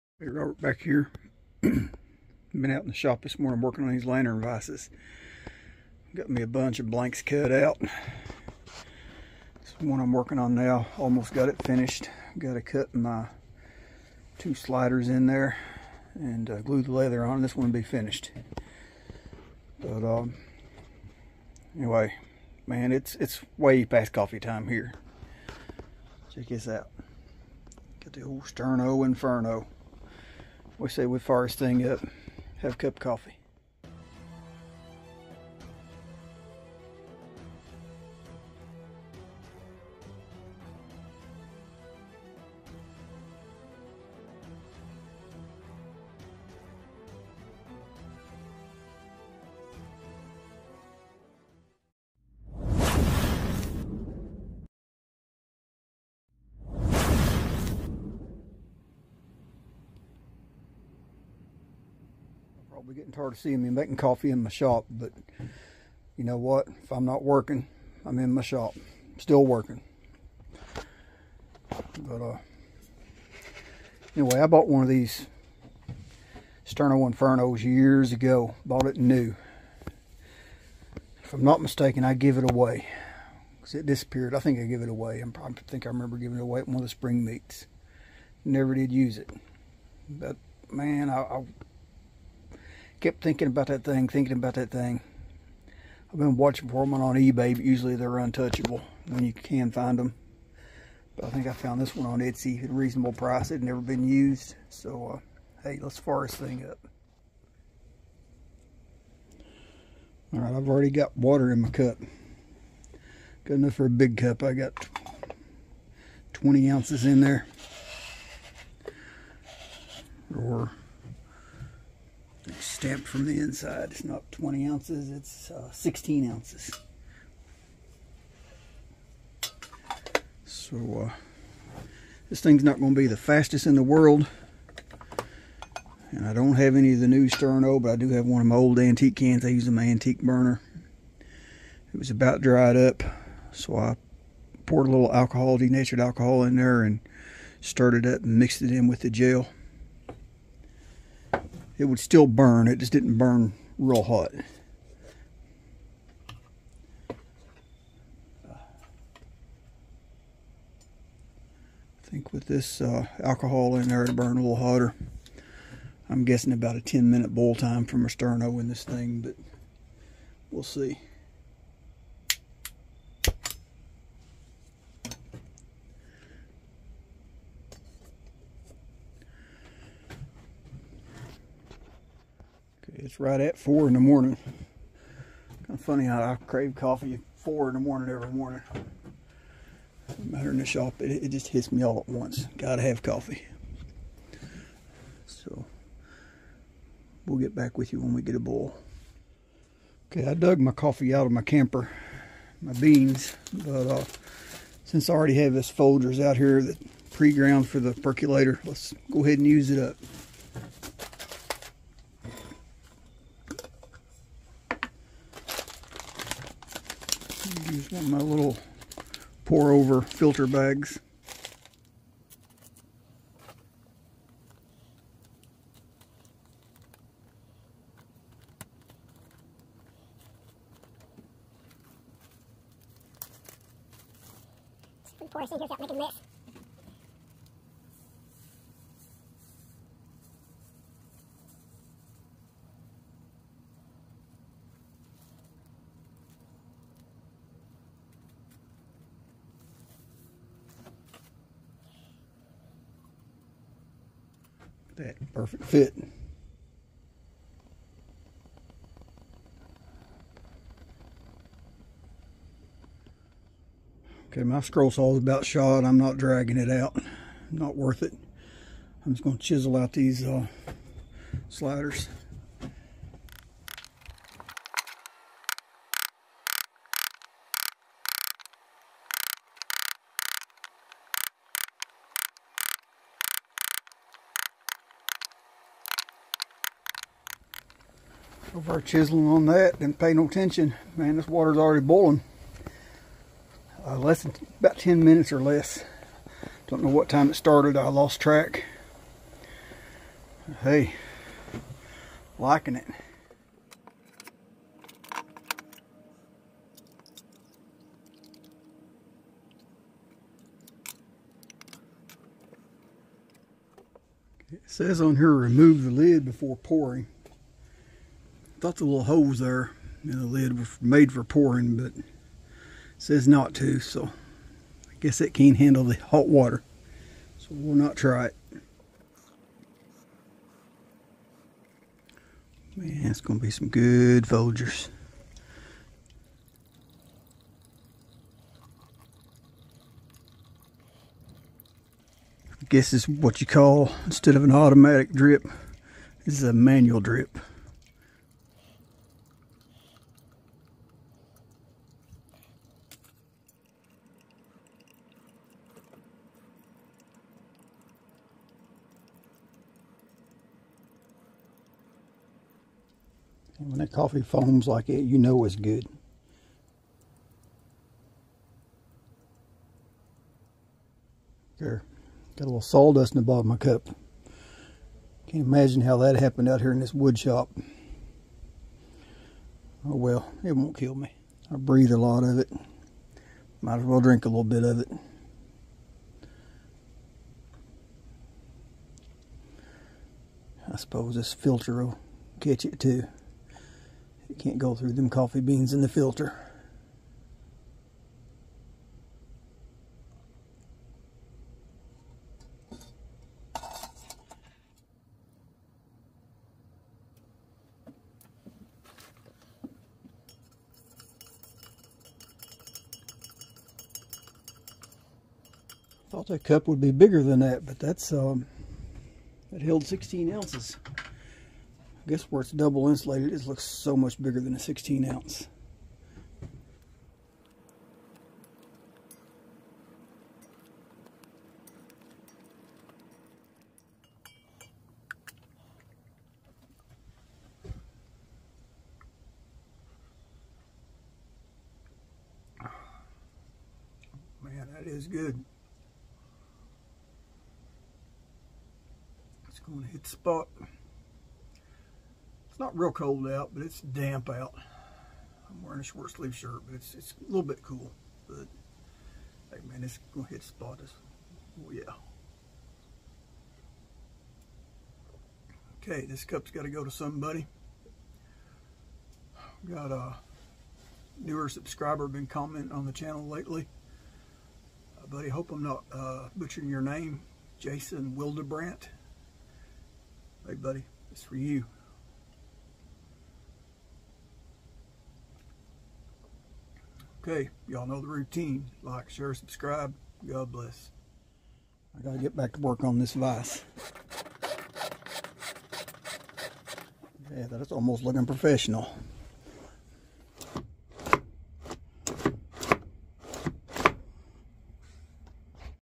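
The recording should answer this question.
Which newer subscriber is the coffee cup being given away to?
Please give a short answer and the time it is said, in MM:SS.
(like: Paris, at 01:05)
Jason Wildebrandt, at 07:57.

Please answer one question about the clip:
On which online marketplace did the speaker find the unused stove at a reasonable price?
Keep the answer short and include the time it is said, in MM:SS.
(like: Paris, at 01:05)
Etsy, at 01:42.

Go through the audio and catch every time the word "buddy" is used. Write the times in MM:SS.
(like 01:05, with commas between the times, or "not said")
07:55, 08:00.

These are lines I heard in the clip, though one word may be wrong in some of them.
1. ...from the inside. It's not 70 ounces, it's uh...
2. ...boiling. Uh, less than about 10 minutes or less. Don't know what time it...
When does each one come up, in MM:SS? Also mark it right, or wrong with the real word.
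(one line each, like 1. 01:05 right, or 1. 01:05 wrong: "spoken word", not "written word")
1. 02:03 wrong: "20", not "70"
2. 04:51 right.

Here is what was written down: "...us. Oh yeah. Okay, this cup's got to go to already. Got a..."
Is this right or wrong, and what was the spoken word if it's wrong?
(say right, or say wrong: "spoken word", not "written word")
wrong: "somebody", not "already".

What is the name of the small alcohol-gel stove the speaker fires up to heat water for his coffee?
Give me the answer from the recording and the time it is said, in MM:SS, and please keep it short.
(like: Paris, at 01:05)
Sterno Inferno, at 00:28.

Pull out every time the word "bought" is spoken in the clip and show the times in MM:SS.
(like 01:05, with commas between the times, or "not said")
01:14, 01:18.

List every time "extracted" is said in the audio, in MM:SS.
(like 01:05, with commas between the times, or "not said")
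not said.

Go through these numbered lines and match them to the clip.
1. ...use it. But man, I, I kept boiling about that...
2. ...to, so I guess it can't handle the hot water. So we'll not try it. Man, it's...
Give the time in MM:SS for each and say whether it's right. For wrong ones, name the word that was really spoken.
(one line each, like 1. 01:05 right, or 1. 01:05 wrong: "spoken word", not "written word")
1. 01:28 wrong: "thinking", not "boiling"
2. 05:23 right.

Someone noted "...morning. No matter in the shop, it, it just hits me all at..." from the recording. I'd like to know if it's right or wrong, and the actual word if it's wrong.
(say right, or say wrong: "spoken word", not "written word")
right.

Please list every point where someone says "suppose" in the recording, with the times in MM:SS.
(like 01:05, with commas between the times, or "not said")
06:30.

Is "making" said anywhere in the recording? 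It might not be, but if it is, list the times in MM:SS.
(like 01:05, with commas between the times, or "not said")
01:03, 03:55.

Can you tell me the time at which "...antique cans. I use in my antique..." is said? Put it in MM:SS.
02:18.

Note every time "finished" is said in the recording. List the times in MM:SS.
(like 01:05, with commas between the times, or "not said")
00:11, 00:17.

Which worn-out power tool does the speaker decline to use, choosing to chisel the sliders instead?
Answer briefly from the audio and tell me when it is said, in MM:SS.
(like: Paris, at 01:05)
scroll saw, at 04:24.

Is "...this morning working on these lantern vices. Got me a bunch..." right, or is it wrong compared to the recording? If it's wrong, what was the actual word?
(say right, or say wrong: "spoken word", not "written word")
right.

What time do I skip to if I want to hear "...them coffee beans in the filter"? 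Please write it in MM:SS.
06:34.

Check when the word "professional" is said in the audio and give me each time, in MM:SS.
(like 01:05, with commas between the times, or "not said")
08:18.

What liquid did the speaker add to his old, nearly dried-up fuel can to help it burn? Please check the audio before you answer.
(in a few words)
denatured alcohol.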